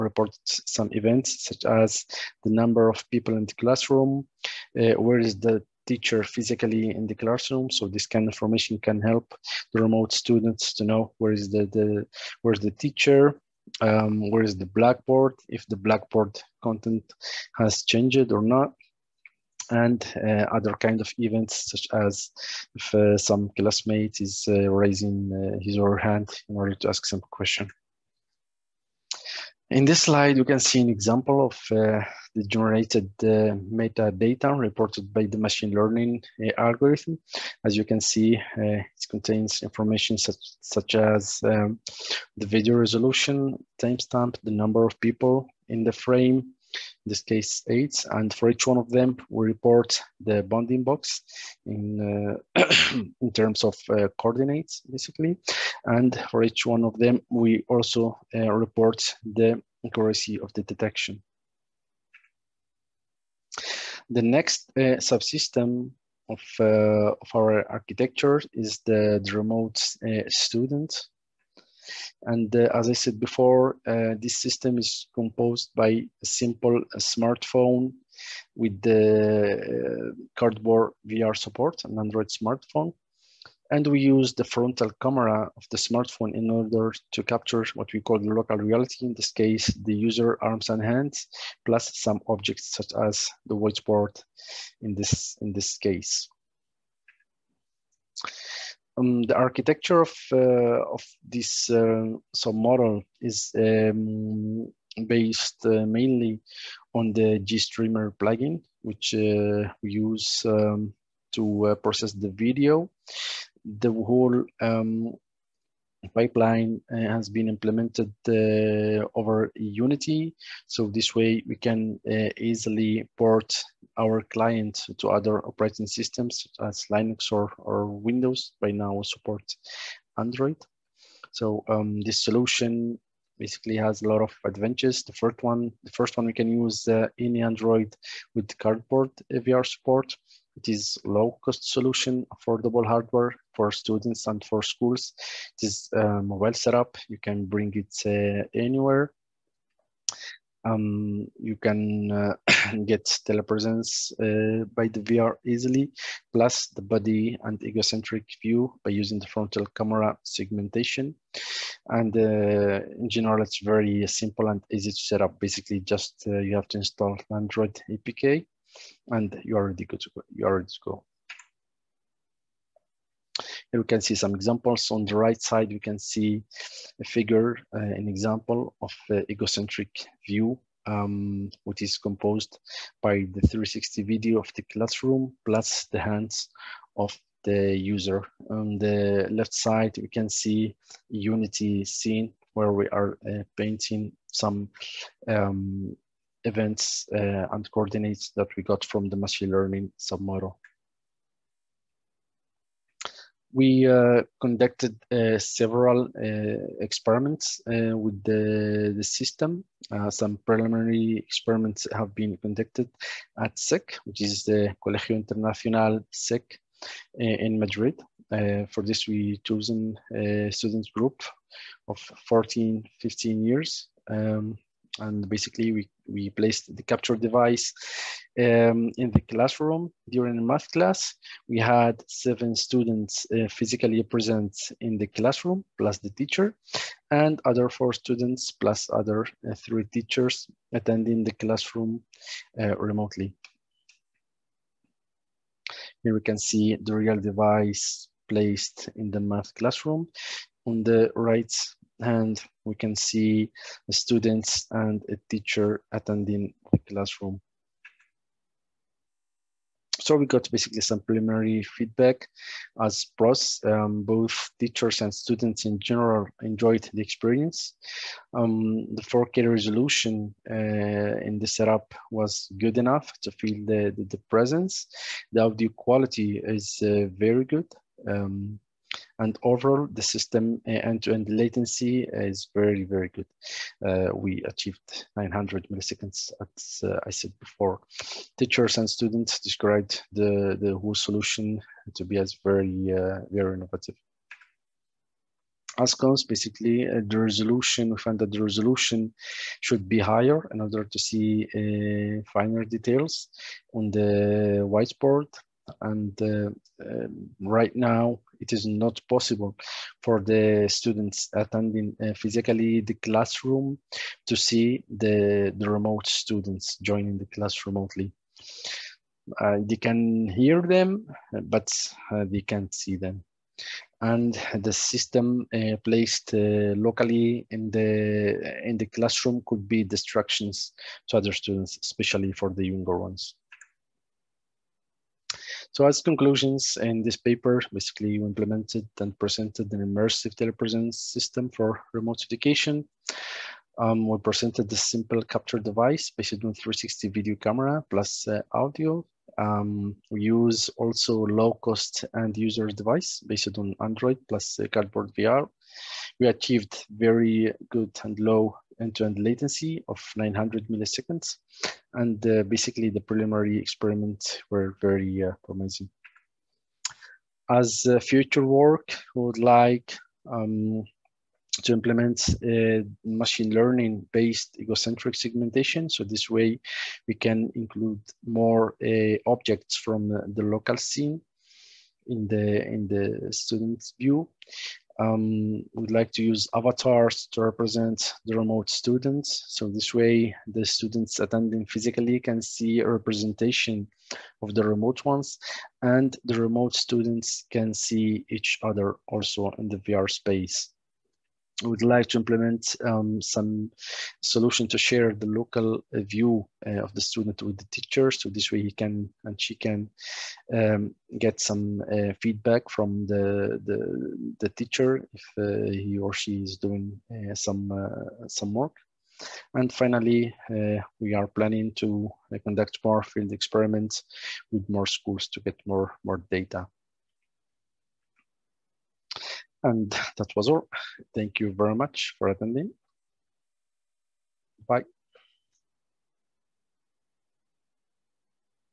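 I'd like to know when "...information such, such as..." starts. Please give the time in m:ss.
0:39.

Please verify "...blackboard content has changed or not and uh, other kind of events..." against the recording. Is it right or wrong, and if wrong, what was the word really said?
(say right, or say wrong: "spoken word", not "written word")
right.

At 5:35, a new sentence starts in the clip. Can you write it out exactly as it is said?
So as conclusions in this paper, basically you implemented and presented an immersive telepresence system for remote education.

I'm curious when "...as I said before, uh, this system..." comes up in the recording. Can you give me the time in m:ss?
1:12.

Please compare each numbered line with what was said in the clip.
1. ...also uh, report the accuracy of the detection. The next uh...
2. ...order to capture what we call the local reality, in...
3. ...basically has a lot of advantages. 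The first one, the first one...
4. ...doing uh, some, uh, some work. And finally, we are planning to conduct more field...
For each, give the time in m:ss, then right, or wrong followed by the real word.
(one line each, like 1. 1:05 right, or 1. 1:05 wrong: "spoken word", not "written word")
1. 0:57 right
2. 1:26 right
3. 2:13 right
4. 6:56 right.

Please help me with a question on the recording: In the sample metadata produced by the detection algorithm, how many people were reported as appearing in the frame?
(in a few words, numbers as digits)
8.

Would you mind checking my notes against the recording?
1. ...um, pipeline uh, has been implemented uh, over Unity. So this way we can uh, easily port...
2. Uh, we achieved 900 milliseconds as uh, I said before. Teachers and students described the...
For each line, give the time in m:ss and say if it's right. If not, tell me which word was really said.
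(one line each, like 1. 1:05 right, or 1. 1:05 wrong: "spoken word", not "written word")
1. 1:54 right
2. 4:43 right.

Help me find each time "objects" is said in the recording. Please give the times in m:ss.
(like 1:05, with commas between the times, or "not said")
1:32, 6:19.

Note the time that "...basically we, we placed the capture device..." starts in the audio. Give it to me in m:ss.
3:45.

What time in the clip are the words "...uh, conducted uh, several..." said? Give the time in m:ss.
3:23.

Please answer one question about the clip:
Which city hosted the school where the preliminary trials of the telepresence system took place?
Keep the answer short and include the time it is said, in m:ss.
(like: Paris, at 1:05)
Madrid, at 3:37.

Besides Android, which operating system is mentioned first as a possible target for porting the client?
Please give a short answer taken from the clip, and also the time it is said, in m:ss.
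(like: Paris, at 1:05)
Linux, at 2:06.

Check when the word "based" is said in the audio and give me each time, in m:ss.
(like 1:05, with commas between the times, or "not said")
1:45, 5:46, 5:53, 6:14.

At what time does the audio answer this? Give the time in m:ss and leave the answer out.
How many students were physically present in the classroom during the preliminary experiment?
3:52.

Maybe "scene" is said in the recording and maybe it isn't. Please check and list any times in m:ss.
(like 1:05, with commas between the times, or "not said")
3:11, 6:20.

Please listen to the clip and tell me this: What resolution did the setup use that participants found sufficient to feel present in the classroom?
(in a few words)
4K.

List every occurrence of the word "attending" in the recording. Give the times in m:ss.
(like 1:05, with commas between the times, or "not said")
4:00, 4:15, 5:11, 6:31, 7:12.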